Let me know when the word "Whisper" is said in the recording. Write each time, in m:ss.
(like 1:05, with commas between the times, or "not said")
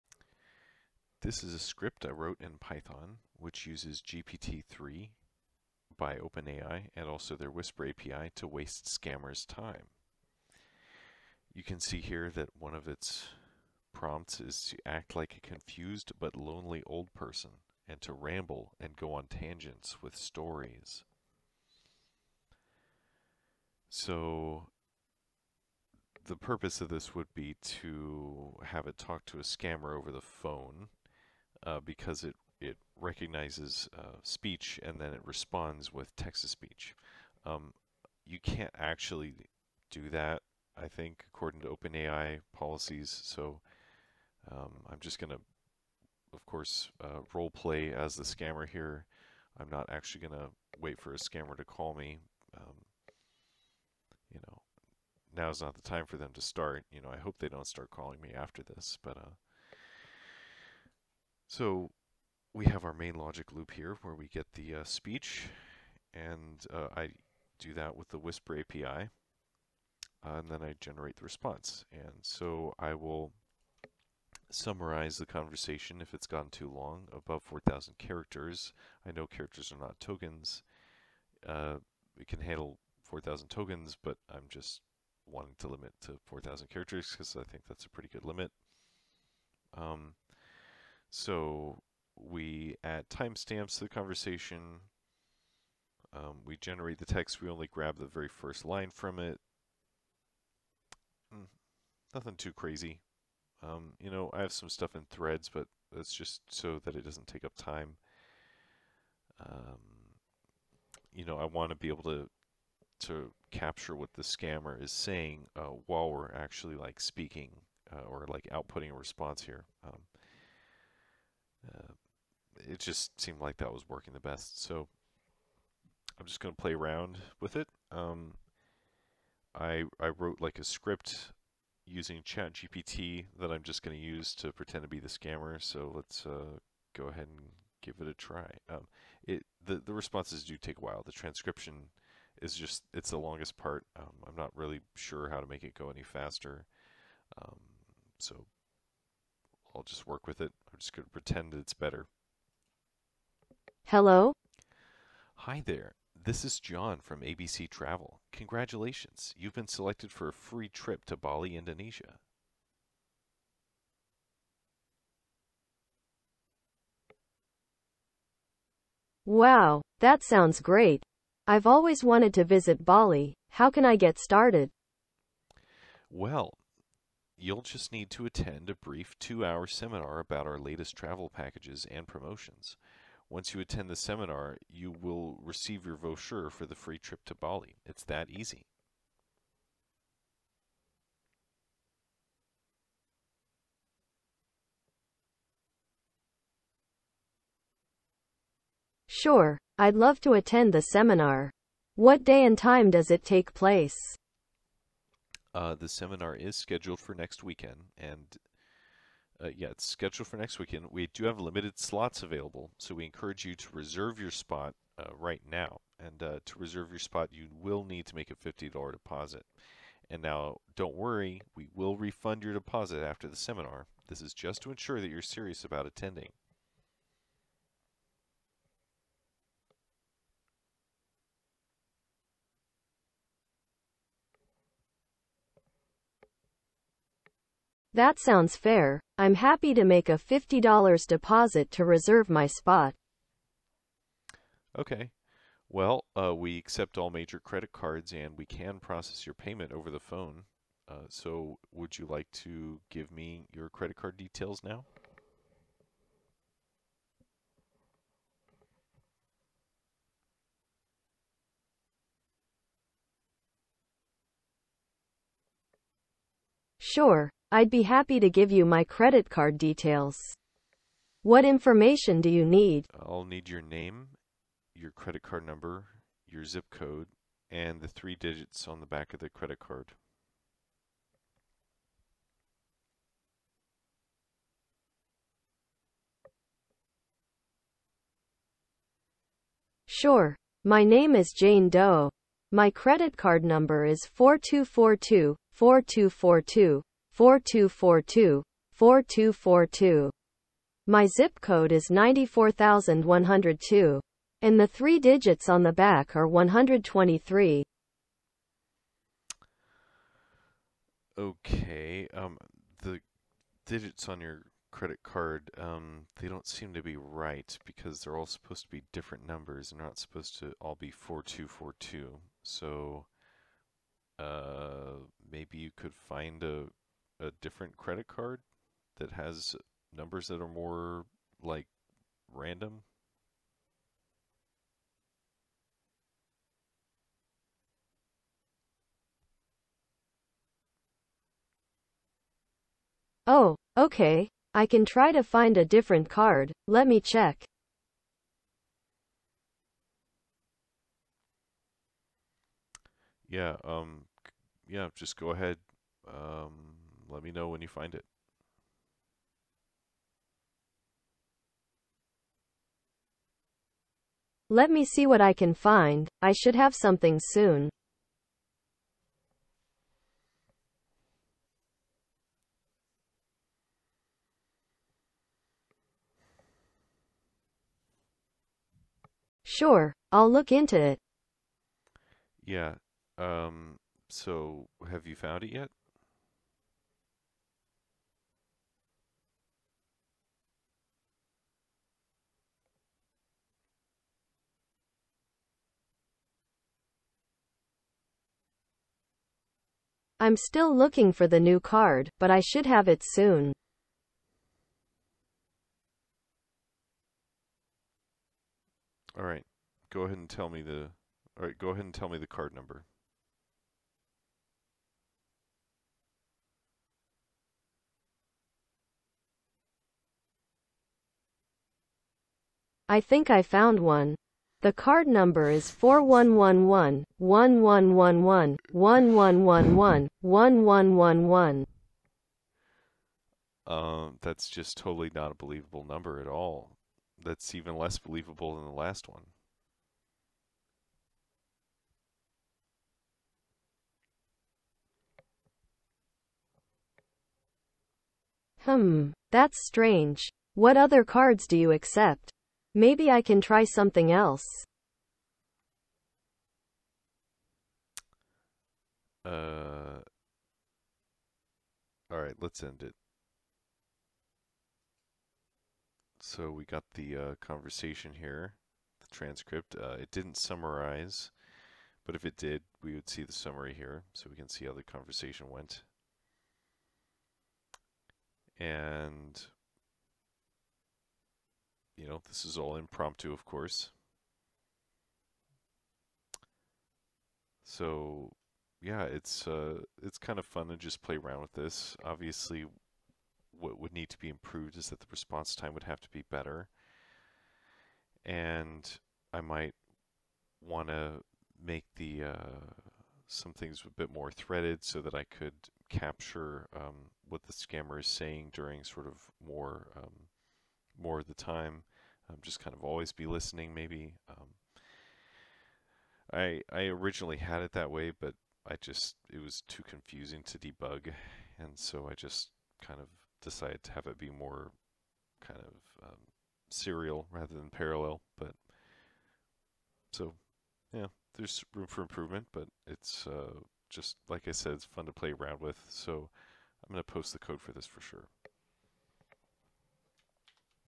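0:07, 1:08.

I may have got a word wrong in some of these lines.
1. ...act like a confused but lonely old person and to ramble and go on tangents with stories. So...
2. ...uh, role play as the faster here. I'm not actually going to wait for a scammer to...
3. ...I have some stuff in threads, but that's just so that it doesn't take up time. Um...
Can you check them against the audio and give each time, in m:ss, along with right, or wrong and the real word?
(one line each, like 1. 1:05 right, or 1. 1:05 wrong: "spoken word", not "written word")
1. 0:14 right
2. 0:47 wrong: "scammer", not "faster"
3. 1:44 right.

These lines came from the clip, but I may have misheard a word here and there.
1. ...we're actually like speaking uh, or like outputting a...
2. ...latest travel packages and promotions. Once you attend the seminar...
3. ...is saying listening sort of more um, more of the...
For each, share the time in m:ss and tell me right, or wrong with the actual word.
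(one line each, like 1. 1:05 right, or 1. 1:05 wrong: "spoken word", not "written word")
1. 1:56 right
2. 3:00 right
3. 8:27 wrong: "during", not "listening".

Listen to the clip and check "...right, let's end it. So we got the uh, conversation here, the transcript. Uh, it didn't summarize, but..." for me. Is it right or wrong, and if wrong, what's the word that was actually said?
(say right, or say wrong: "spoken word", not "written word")
right.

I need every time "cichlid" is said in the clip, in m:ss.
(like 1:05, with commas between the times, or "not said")
not said.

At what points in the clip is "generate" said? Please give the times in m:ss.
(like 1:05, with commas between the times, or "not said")
1:10, 1:36.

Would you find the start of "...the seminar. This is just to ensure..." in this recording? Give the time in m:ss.
3:43.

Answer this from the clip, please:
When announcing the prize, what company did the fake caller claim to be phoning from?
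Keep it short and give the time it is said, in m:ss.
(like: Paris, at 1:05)
ABC Travel, at 2:37.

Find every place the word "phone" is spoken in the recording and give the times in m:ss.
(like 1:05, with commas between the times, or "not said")
0:30, 4:09.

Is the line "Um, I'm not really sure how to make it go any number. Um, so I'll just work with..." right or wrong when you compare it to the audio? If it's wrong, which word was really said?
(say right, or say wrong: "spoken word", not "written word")
wrong: "faster", not "number".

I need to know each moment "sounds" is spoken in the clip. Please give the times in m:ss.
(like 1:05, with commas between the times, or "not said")
2:50, 3:58.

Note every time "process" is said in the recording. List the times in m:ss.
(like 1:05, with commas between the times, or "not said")
4:08.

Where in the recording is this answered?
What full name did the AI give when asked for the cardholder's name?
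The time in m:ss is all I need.
4:51.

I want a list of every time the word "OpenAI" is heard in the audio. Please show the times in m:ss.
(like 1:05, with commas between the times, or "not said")
0:06, 0:41.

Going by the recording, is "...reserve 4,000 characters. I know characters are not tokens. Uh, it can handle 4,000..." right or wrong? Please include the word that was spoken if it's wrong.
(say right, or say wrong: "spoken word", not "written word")
wrong: "above", not "reserve".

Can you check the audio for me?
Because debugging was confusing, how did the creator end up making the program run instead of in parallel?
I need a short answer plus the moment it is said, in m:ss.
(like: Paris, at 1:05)
serial, at 8:46.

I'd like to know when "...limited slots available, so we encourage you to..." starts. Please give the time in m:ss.
3:31.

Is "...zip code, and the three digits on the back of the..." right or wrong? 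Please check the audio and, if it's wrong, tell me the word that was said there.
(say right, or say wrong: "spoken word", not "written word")
right.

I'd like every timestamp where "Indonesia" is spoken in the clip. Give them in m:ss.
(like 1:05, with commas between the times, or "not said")
2:41.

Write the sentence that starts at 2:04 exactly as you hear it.
So I'm just going to play around with it.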